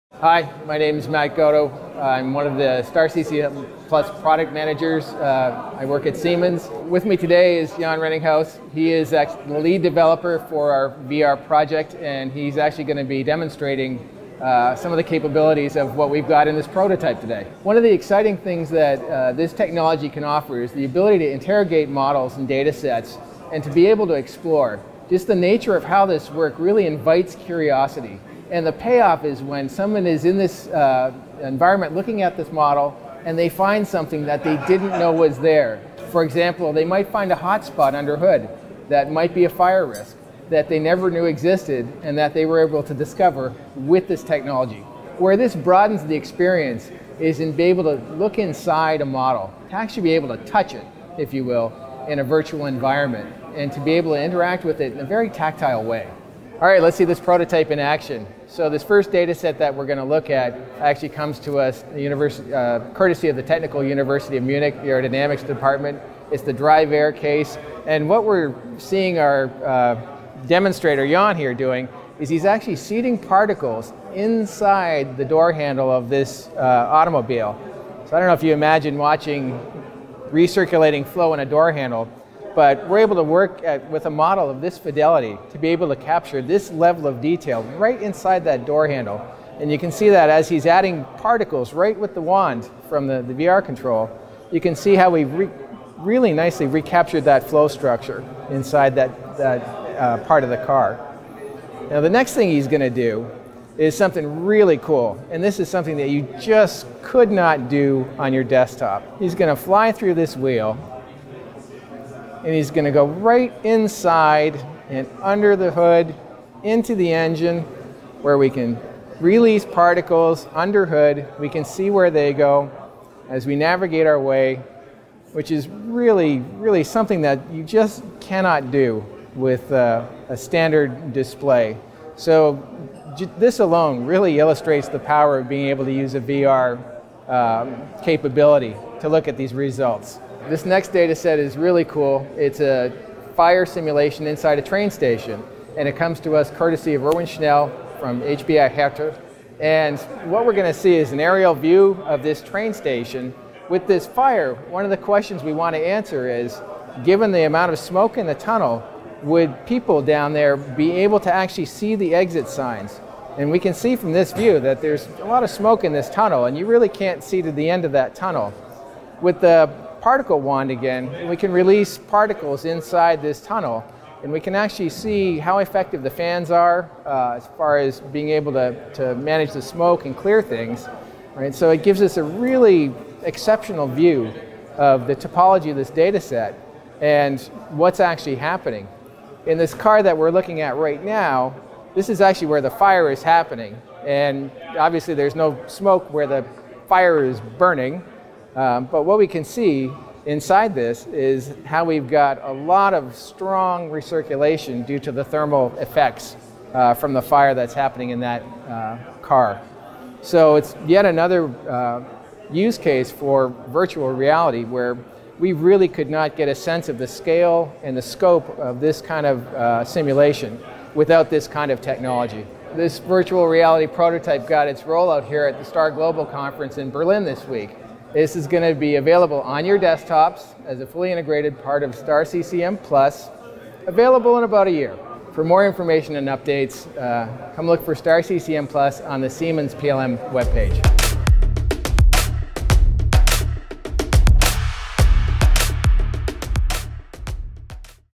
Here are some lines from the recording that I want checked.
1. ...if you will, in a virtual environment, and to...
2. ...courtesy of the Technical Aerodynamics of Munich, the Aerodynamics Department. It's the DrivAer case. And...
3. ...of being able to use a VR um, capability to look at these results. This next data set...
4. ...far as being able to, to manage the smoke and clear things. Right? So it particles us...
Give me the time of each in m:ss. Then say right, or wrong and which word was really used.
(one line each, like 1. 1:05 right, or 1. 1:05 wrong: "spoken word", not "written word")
1. 0:51 right
2. 1:02 wrong: "University", not "Aerodynamics"
3. 2:15 right
4. 2:57 wrong: "gives", not "particles".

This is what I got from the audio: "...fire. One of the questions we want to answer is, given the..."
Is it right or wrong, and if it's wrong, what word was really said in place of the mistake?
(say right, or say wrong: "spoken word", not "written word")
right.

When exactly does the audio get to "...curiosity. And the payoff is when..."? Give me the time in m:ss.
0:27.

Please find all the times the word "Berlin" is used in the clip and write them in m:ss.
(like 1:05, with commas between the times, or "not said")
3:46.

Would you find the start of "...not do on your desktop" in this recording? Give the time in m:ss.
1:47.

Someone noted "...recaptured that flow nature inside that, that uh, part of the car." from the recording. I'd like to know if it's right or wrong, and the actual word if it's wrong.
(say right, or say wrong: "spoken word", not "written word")
wrong: "structure", not "nature".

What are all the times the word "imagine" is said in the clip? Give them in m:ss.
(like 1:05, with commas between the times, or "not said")
1:18.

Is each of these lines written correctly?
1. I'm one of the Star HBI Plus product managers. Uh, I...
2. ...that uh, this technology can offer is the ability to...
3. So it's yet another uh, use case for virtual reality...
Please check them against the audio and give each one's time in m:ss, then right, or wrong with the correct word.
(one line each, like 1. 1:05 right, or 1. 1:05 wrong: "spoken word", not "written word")
1. 0:01 wrong: "CCM", not "HBI"
2. 0:18 right
3. 3:30 right.